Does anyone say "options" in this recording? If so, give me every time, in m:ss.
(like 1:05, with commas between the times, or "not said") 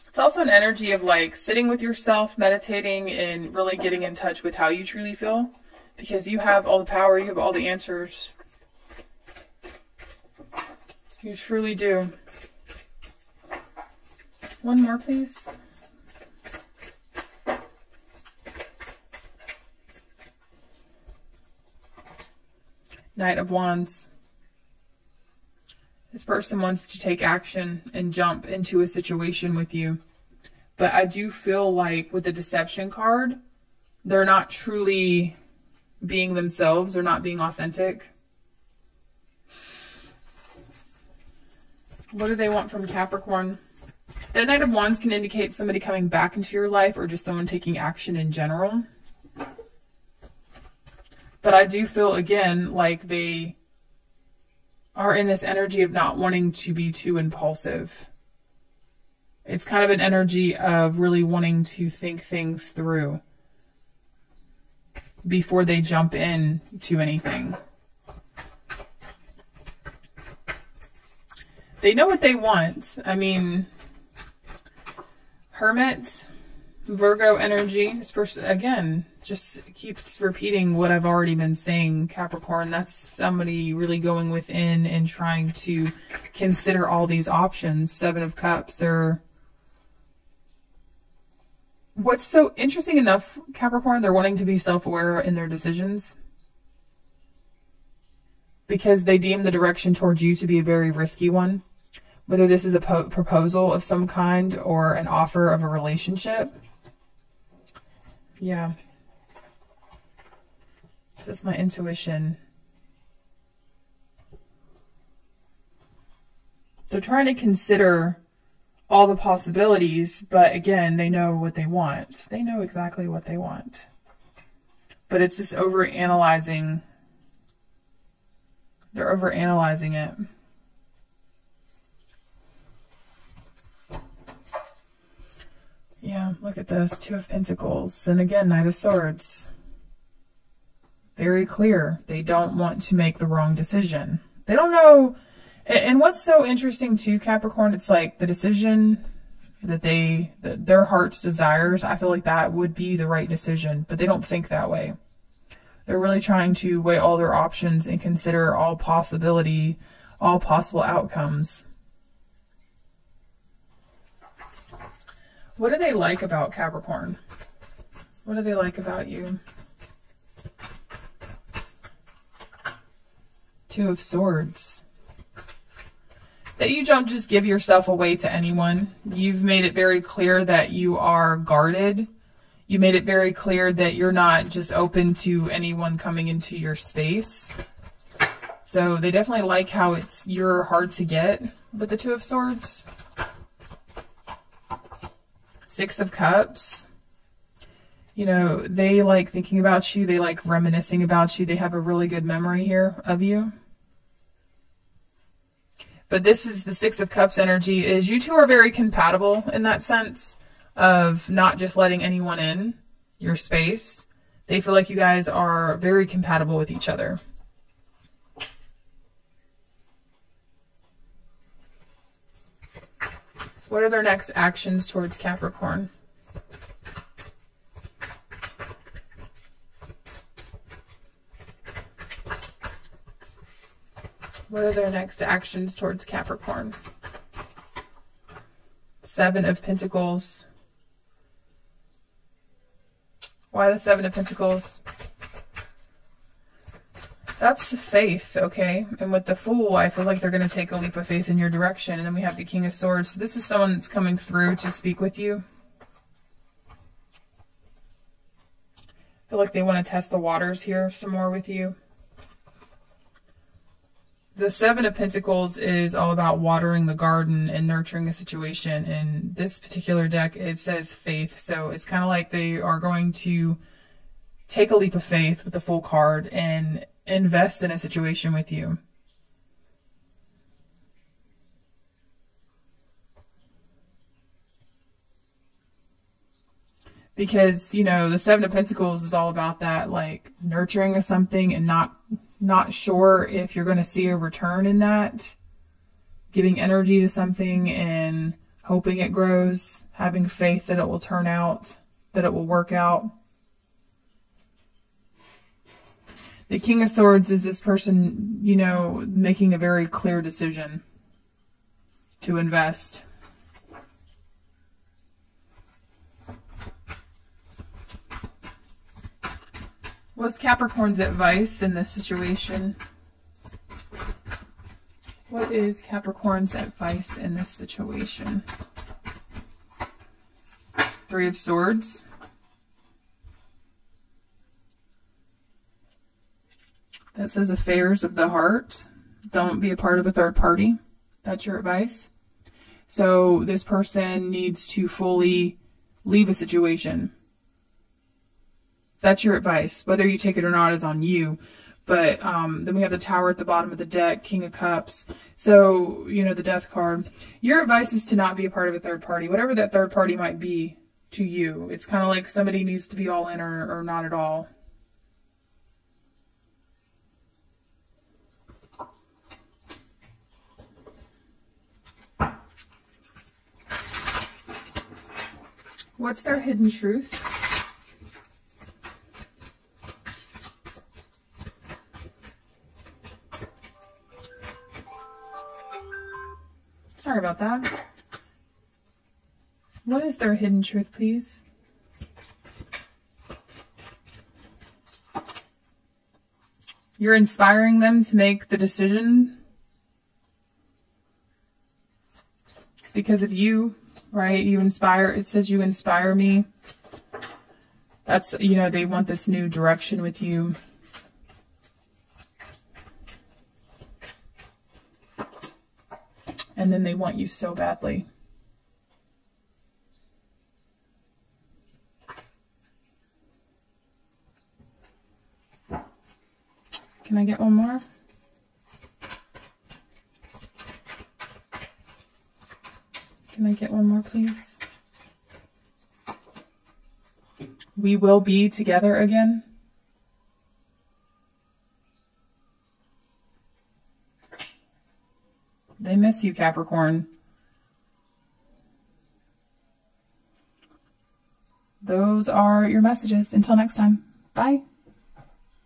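1:27, 2:37.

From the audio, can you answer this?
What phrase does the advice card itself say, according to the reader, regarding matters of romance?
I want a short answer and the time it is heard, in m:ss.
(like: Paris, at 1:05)
affairs of the heart, at 5:37.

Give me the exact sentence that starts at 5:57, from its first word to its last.
Your advice is to not be a part of a third party, whatever that third party might be to you.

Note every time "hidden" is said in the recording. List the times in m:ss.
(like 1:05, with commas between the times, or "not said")
6:16, 6:30.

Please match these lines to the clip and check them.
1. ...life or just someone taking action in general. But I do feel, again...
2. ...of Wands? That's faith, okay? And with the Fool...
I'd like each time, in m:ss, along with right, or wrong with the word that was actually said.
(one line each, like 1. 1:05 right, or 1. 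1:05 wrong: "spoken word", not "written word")
1. 0:46 right
2. 4:04 wrong: "Pentacles", not "Wands".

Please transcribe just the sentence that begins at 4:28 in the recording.
In this particular deck, it says faith.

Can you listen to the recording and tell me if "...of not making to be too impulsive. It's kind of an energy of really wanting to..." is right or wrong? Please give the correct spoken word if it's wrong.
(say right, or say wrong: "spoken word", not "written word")
wrong: "wanting", not "making".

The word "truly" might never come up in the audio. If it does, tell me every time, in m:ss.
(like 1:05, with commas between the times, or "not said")
0:04, 0:11, 0:34.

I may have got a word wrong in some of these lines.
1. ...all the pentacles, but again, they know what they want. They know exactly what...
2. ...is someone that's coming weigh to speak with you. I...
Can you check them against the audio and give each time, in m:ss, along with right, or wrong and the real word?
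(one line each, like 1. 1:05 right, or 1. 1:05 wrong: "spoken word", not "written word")
1. 1:58 wrong: "possibilities", not "pentacles"
2. 4:13 wrong: "through", not "weigh".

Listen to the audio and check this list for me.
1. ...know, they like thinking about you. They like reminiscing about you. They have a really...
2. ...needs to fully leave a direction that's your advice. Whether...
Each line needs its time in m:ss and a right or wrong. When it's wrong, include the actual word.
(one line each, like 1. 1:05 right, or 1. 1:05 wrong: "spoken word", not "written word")
1. 3:18 right
2. 5:44 wrong: "situation", not "direction".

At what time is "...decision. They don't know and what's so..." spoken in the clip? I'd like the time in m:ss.
2:23.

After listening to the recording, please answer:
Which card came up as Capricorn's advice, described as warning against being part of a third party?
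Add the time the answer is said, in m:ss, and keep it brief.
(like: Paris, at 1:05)
Three of Swords, at 5:31.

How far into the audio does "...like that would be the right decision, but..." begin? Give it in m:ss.
2:32.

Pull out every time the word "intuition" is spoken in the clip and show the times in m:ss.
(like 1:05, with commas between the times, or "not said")
1:51.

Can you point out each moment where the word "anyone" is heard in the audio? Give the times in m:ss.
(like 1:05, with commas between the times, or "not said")
2:58, 3:05, 3:32.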